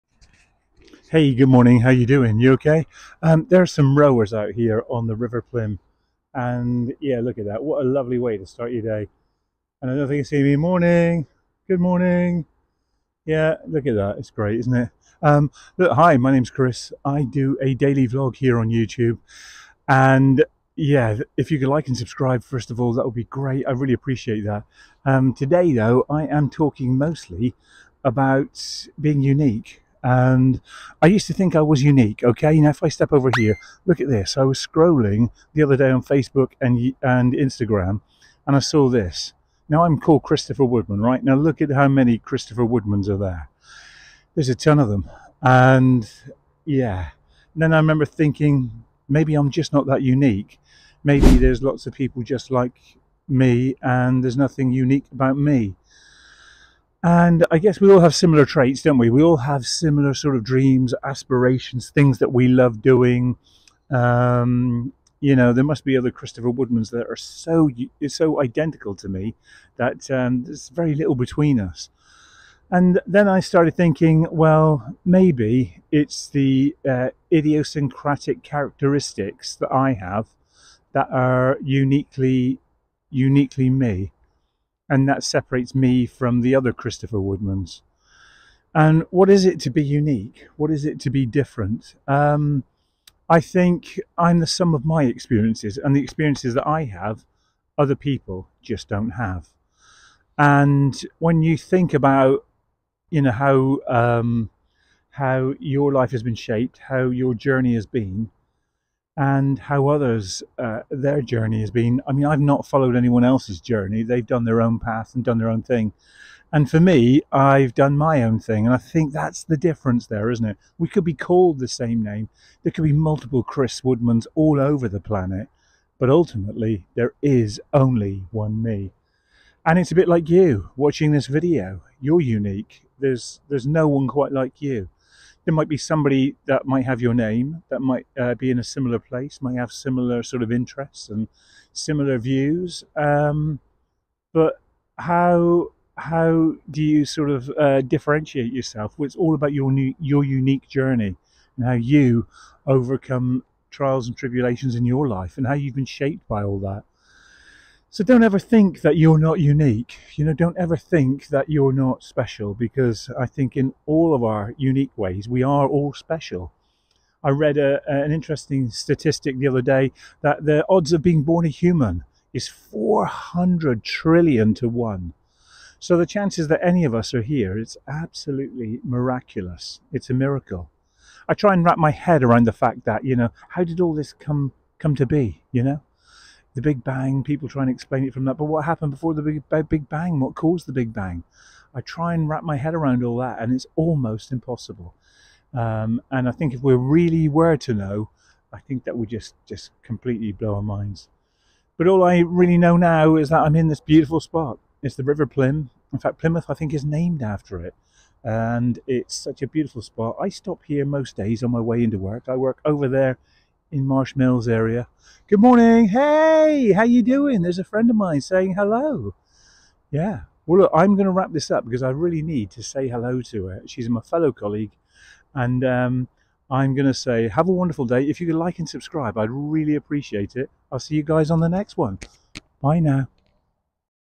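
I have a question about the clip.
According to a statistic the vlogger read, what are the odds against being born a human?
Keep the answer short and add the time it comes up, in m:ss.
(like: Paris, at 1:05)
400 trillion to 1, at 2:52.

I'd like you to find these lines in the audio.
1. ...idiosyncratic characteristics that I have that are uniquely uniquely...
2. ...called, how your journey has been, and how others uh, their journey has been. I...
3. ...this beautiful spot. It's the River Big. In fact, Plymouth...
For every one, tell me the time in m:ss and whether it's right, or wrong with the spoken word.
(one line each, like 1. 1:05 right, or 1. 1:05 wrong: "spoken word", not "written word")
1. 1:17 right
2. 1:46 wrong: "shaped", not "called"
3. 3:23 wrong: "Plym", not "Big".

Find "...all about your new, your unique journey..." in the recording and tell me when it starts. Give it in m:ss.
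2:29.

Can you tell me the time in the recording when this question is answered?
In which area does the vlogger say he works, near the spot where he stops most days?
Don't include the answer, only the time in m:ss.
3:33.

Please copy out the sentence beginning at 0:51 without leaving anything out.
Maybe there's lots of people just like me, and there's nothing unique about me.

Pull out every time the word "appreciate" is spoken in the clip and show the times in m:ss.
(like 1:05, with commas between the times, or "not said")
0:23, 3:49.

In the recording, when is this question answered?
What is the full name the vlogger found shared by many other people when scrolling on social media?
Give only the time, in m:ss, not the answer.
0:40.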